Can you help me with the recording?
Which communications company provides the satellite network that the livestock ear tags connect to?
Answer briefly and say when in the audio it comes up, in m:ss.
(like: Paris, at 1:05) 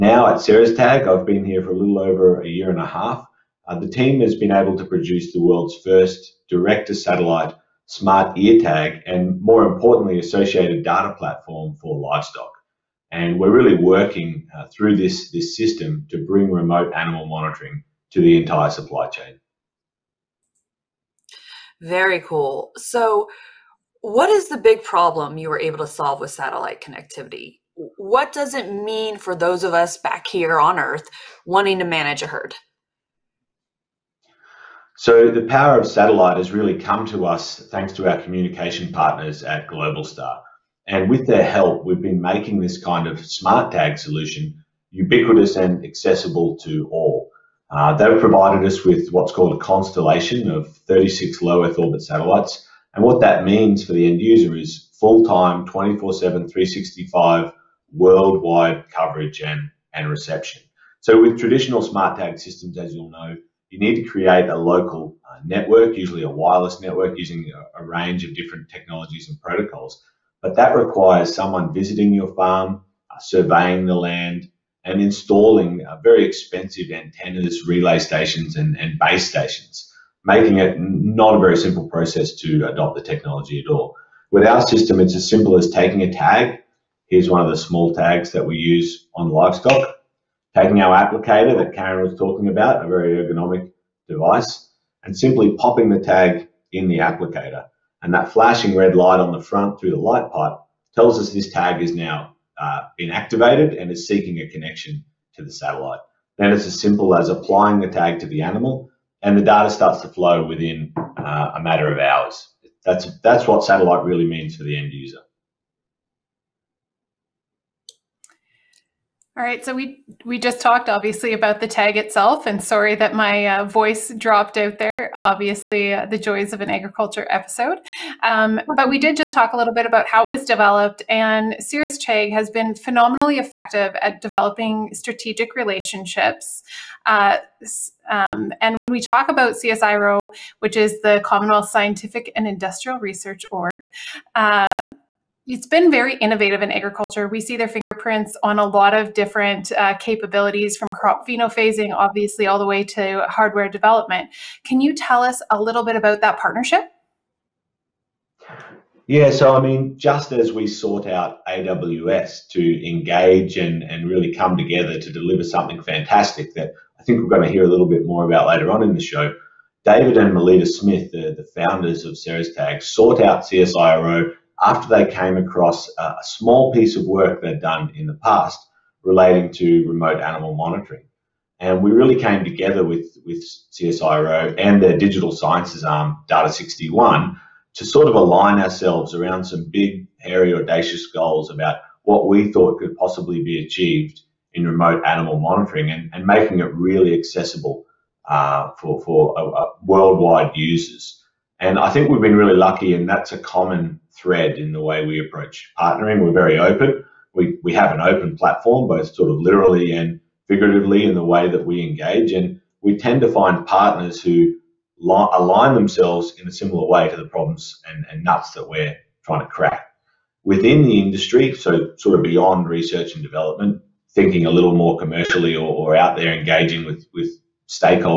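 Globalstar, at 0:39.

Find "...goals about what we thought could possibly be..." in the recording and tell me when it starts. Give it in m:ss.
3:11.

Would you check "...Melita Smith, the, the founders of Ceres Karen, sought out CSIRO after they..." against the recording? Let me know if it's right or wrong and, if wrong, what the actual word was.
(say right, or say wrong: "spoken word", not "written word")
wrong: "Tag", not "Karen".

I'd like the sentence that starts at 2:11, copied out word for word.
And Ceres Tag has been phenomenally effective at developing strategic relationships.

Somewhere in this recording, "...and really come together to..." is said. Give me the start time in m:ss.
2:43.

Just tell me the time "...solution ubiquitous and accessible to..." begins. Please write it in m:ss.
0:43.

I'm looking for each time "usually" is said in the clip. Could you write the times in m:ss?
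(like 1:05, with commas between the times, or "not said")
1:05.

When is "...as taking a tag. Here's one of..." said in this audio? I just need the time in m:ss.
1:25.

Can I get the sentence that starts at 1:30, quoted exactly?
Taking our applicator that Karen was talking about, a very ergonomic device, and simply popping the tag in the applicator.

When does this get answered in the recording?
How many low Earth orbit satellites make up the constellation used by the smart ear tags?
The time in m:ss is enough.
0:50.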